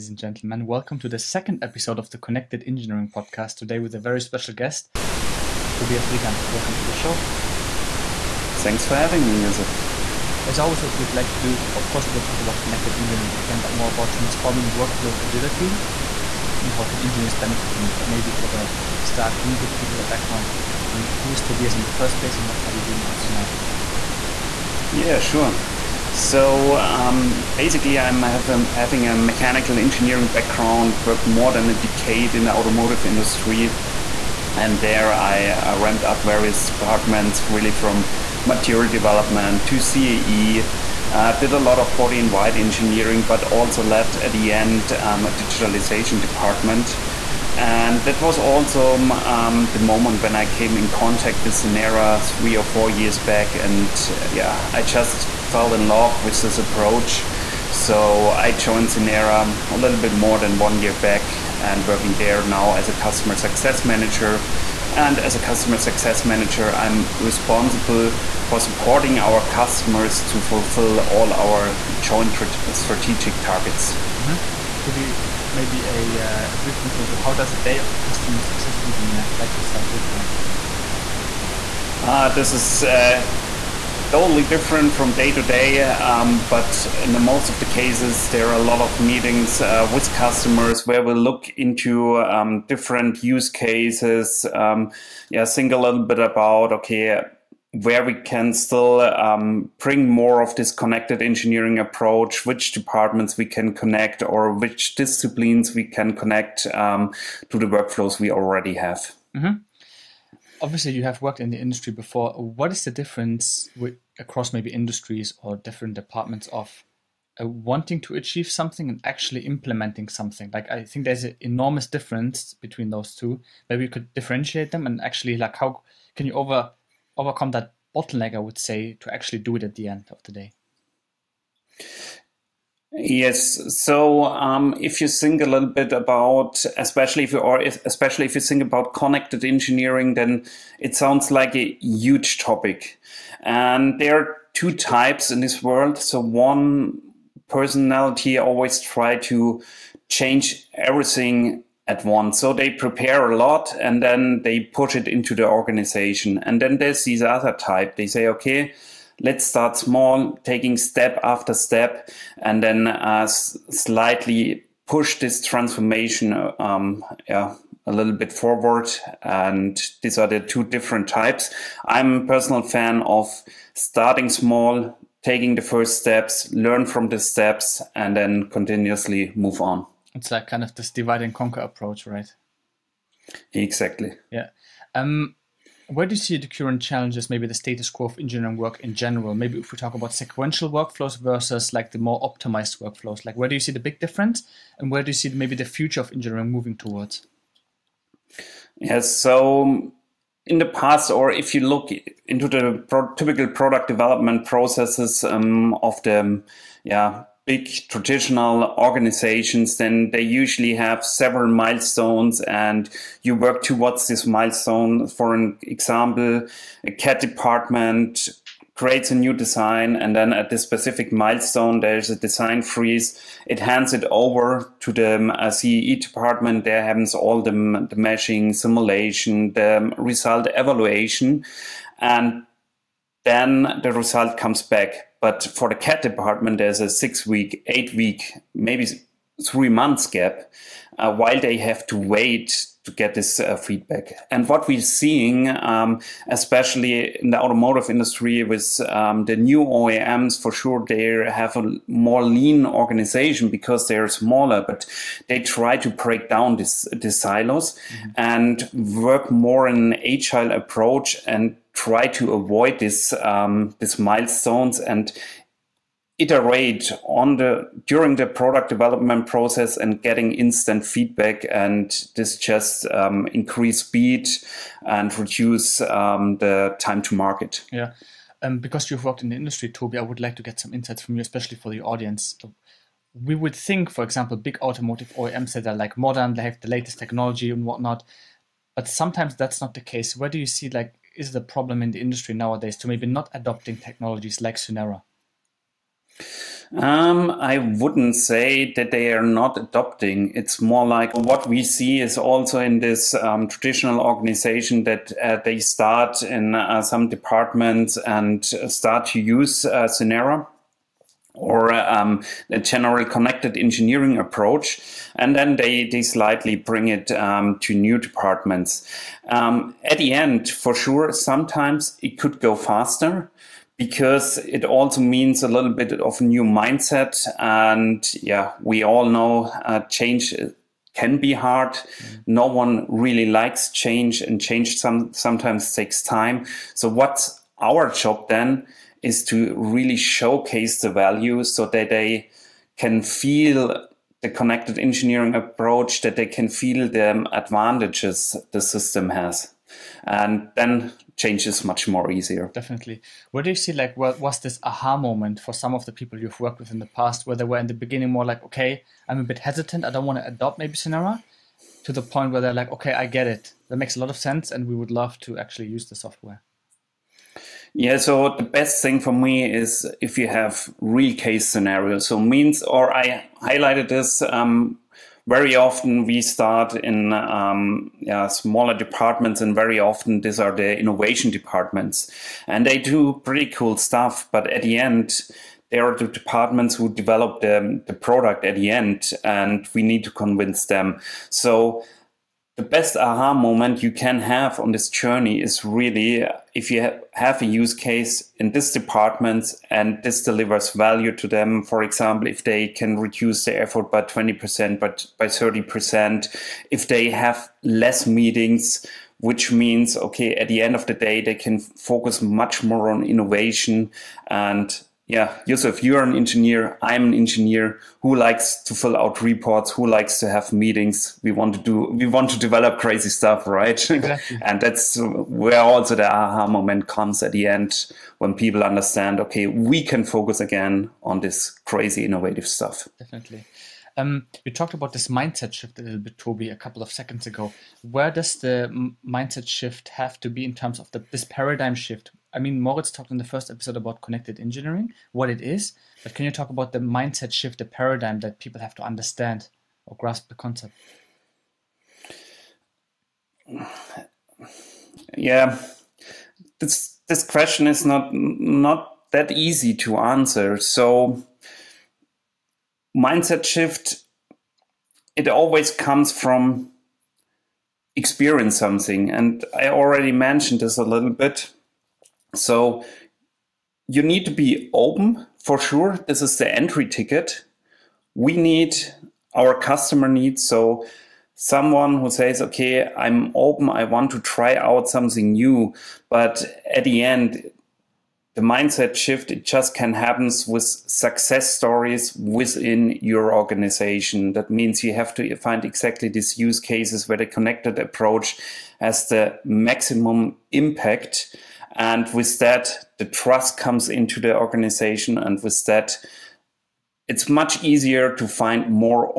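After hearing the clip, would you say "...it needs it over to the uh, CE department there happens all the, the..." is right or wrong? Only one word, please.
wrong.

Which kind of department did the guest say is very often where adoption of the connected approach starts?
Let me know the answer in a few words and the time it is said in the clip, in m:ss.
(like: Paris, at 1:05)
innovation departments, at 6:20.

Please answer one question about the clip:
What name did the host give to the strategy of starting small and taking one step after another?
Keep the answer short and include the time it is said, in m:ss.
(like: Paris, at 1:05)
divide and conquer, at 3:00.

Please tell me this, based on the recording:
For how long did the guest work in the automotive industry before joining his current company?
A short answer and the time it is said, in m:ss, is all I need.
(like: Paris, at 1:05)
more than a decade, at 0:31.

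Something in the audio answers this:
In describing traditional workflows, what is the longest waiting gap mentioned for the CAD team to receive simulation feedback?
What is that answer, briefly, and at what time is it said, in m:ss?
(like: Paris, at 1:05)
3 months, at 3:59.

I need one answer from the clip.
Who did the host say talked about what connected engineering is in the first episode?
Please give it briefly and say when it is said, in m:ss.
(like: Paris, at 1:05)
Moritz, at 7:22.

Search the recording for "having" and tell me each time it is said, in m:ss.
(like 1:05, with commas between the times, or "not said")
0:08, 0:28.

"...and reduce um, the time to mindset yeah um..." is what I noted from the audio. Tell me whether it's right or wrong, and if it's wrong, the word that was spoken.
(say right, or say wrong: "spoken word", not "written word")
wrong: "market", not "mindset".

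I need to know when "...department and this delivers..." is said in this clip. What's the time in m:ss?
6:38.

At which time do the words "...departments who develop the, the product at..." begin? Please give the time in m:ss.
6:26.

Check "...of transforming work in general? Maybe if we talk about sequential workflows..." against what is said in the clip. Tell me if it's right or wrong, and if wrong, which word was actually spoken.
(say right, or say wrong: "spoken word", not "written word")
wrong: "engineering", not "transforming".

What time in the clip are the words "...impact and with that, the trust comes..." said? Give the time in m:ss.
8:20.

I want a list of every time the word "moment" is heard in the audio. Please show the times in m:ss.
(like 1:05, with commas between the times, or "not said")
0:49, 5:54, 6:33, 7:06.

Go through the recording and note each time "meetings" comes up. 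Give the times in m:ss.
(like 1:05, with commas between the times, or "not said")
1:28, 6:48, 7:00.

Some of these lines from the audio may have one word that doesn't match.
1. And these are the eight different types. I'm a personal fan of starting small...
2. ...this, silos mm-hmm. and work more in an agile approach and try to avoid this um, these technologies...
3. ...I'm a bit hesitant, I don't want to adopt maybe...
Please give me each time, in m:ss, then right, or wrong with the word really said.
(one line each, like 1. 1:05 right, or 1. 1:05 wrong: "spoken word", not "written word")
1. 2:49 wrong: "two", not "eight"
2. 4:16 wrong: "milestones", not "technologies"
3. 5:59 right.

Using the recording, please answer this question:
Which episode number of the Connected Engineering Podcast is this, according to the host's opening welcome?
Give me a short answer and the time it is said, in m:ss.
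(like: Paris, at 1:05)
second, at 0:01.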